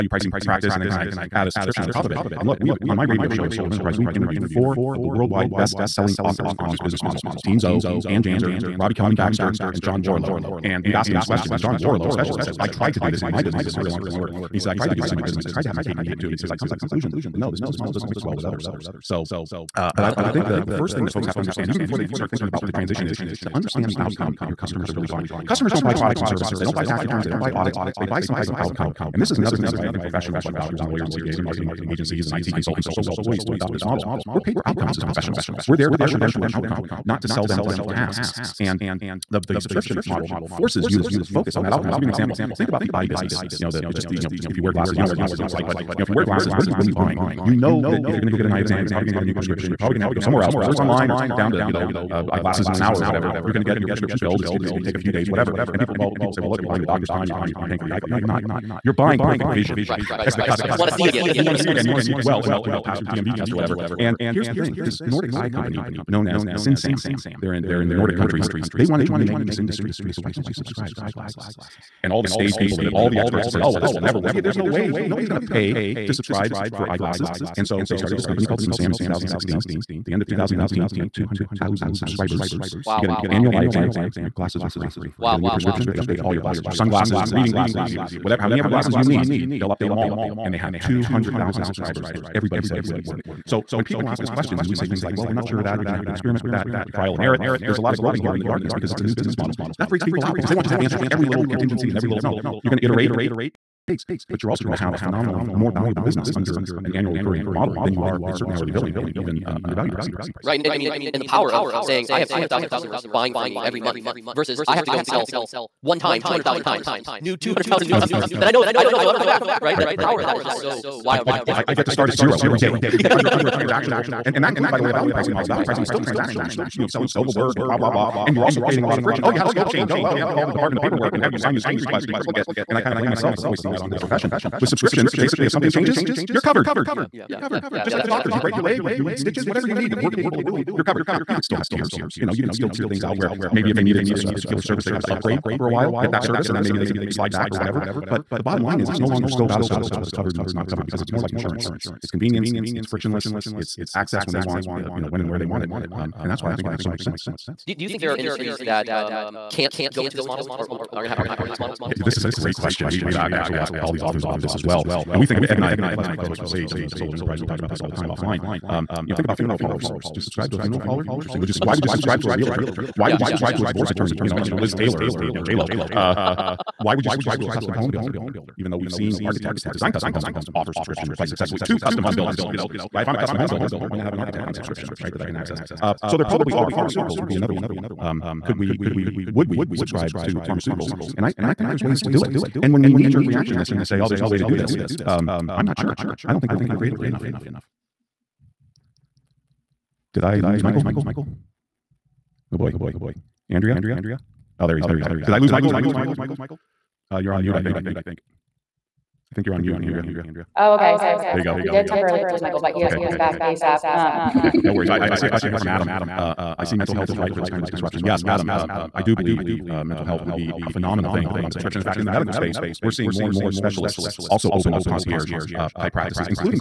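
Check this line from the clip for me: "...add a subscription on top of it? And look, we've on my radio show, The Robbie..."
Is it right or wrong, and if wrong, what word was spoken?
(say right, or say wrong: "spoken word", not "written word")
wrong: "Soul", not "Robbie".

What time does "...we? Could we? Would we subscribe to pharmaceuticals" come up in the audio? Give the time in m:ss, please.
3:08.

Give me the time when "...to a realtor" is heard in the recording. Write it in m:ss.
2:52.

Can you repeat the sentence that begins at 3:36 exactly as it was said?
Uh, I see mental health is right for this kind of disruption.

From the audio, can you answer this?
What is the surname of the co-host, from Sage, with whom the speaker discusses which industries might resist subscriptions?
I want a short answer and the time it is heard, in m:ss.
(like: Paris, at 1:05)
Kless, at 2:45.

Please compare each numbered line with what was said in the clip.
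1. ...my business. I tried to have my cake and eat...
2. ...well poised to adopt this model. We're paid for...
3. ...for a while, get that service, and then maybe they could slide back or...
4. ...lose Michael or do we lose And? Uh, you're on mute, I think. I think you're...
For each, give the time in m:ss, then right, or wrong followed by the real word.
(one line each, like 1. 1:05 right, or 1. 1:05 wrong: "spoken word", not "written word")
1. 0:15 right
2. 0:33 right
3. 2:25 right
4. 3:25 wrong: "Michael", not "And".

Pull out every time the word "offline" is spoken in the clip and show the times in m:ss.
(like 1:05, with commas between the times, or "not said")
2:48.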